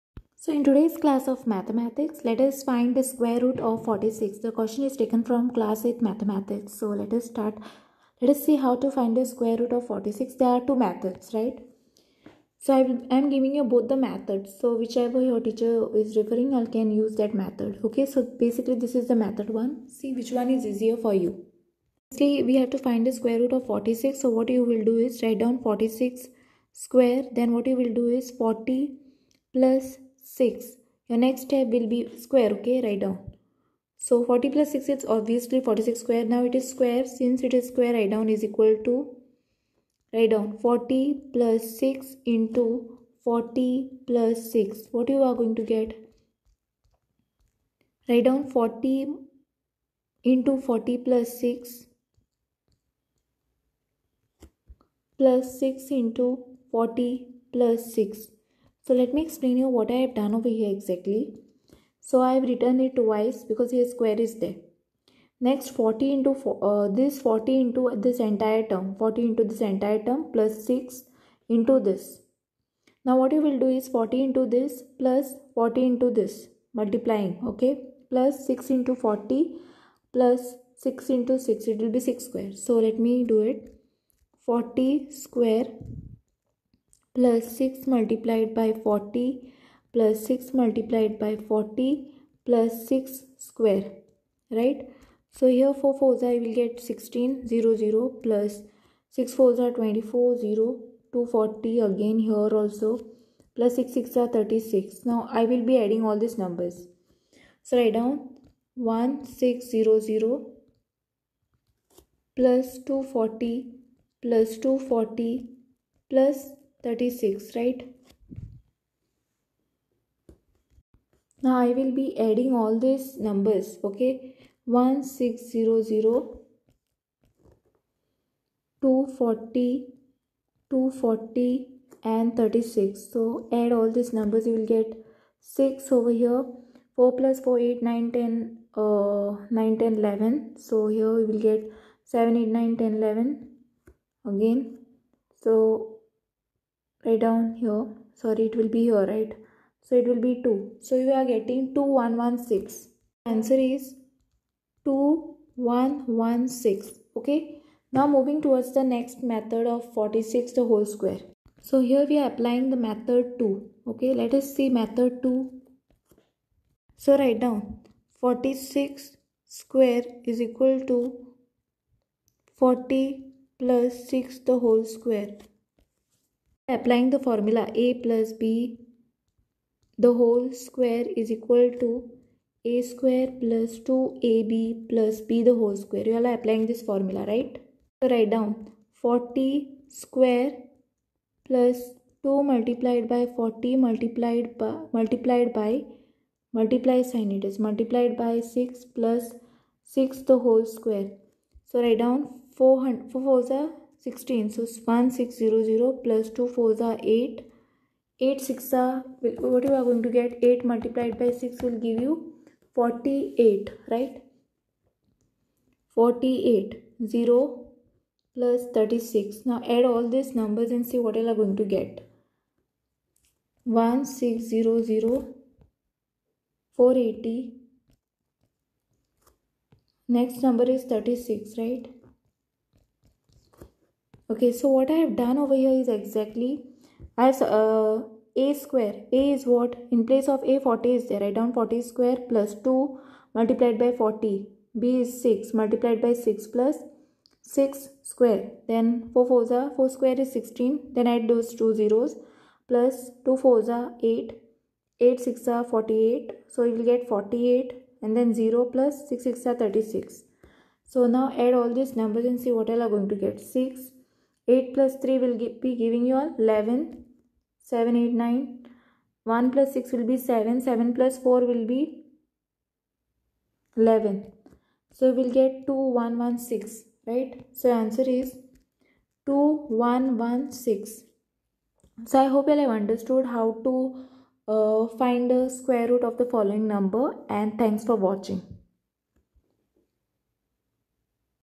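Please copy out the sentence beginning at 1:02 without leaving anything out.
So I have written it twice because here square is there.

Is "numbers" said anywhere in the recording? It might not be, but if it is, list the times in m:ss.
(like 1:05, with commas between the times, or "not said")
1:46, 2:03, 2:14, 3:40, 3:50, 4:22, 4:46.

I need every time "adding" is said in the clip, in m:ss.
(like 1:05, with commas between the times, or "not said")
1:45, 2:02.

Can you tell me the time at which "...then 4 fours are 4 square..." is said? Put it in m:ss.
4:08.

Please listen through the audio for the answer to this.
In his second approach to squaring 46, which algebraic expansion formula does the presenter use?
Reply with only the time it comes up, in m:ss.
2:57.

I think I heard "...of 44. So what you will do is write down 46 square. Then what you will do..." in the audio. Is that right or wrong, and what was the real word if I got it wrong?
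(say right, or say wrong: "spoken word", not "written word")
wrong: "46", not "44".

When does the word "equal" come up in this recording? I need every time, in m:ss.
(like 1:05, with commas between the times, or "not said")
0:38, 2:50, 3:01.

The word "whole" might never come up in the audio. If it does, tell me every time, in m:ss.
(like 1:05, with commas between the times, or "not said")
2:40, 2:54, 3:00, 3:05, 3:20.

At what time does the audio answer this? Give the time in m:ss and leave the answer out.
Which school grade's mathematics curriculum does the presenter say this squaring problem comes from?
0:05.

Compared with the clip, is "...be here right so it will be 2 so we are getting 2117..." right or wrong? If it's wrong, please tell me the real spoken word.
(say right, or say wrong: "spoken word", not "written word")
wrong: "2116", not "2117".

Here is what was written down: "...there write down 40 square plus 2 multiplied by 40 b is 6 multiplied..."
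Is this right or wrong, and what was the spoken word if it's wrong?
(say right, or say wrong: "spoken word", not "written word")
right.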